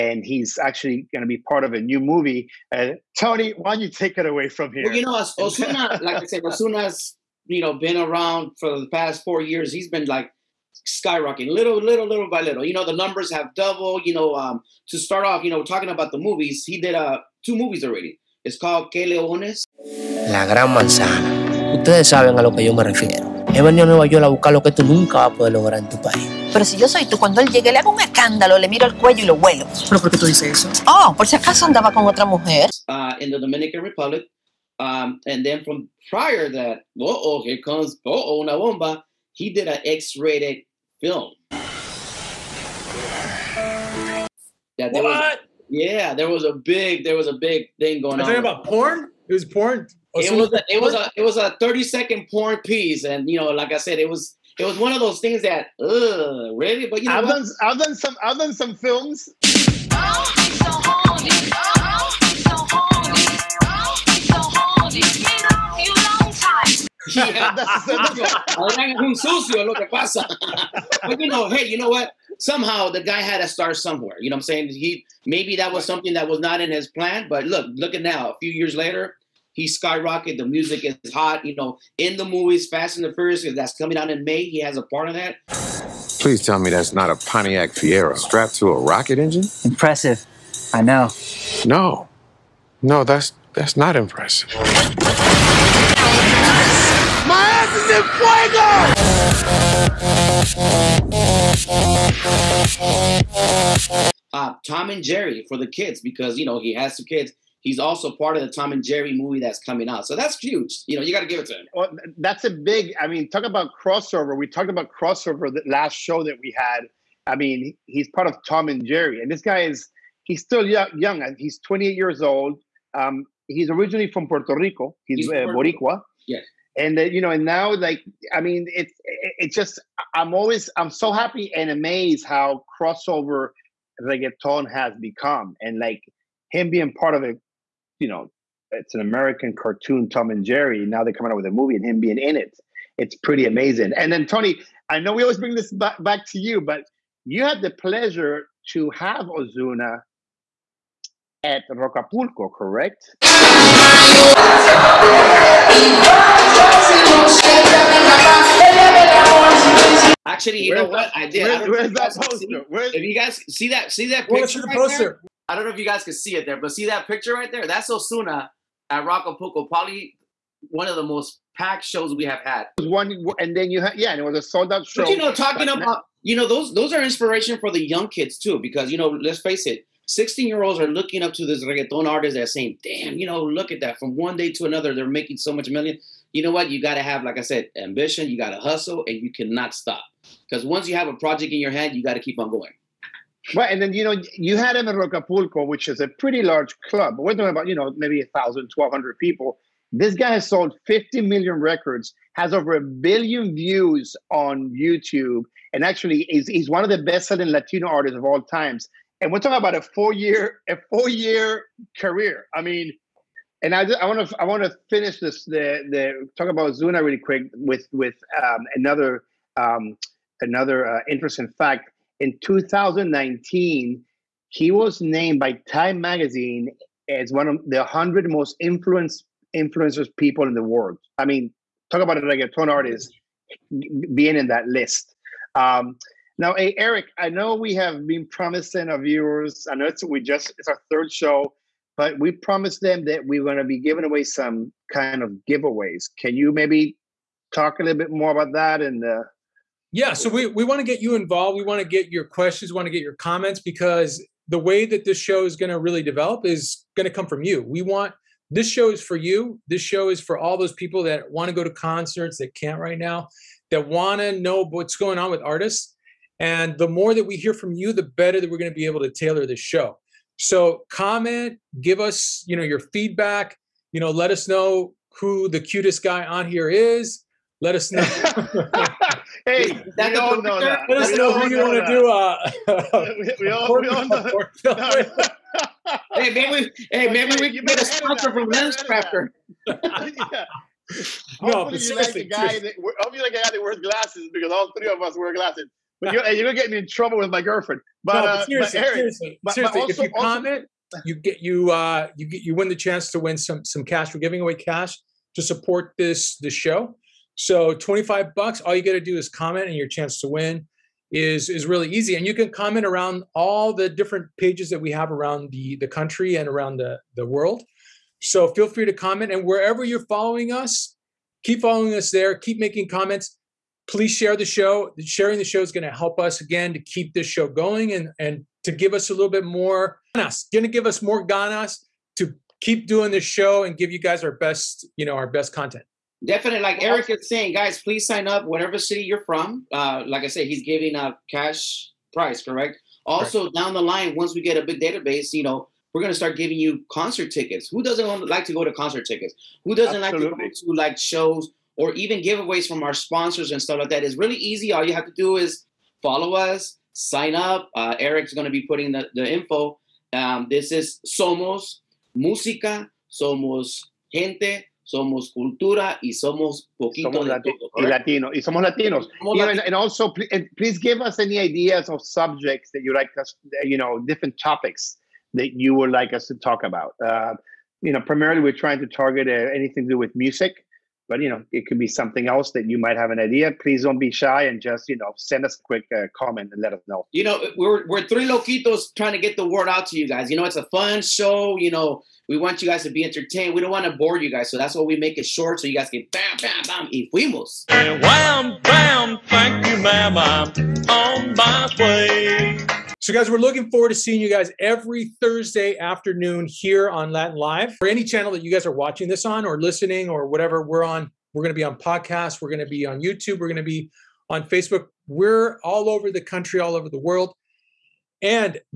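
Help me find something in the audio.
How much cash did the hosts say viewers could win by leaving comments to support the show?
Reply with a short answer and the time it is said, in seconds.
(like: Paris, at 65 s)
$25, at 307 s.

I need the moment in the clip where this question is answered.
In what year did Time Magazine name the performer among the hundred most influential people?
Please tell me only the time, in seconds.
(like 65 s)
222 s.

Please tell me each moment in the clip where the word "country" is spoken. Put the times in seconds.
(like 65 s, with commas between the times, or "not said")
315 s, 416 s.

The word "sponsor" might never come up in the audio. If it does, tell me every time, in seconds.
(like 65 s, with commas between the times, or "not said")
287 s, 352 s.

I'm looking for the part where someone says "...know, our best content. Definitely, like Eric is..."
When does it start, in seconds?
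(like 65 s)
335 s.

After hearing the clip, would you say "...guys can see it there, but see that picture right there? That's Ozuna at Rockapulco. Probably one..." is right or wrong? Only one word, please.
right.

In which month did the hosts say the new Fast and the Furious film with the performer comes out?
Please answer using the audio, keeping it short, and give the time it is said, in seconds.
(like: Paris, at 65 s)
May, at 84 s.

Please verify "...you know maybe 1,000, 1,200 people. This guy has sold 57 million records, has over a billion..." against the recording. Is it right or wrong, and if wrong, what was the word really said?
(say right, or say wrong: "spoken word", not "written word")
wrong: "50", not "57".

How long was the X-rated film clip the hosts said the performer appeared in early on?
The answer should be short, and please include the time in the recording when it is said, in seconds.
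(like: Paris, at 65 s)
30 seconds, at 51 s.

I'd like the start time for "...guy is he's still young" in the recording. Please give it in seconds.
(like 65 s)
119 s.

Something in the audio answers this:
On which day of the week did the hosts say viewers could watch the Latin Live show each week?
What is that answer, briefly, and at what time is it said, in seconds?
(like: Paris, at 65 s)
Thursday, at 405 s.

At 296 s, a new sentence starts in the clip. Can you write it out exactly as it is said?
But you're, you're gonna get me in trouble with my girlfriend.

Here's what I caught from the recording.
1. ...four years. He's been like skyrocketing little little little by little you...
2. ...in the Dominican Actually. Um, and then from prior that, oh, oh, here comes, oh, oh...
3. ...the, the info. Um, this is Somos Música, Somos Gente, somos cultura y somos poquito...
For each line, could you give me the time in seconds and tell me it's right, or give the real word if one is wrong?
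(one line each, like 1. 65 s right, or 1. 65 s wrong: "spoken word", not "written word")
1. 9 s right
2. 33 s wrong: "Republic", not "Actually"
3. 358 s right.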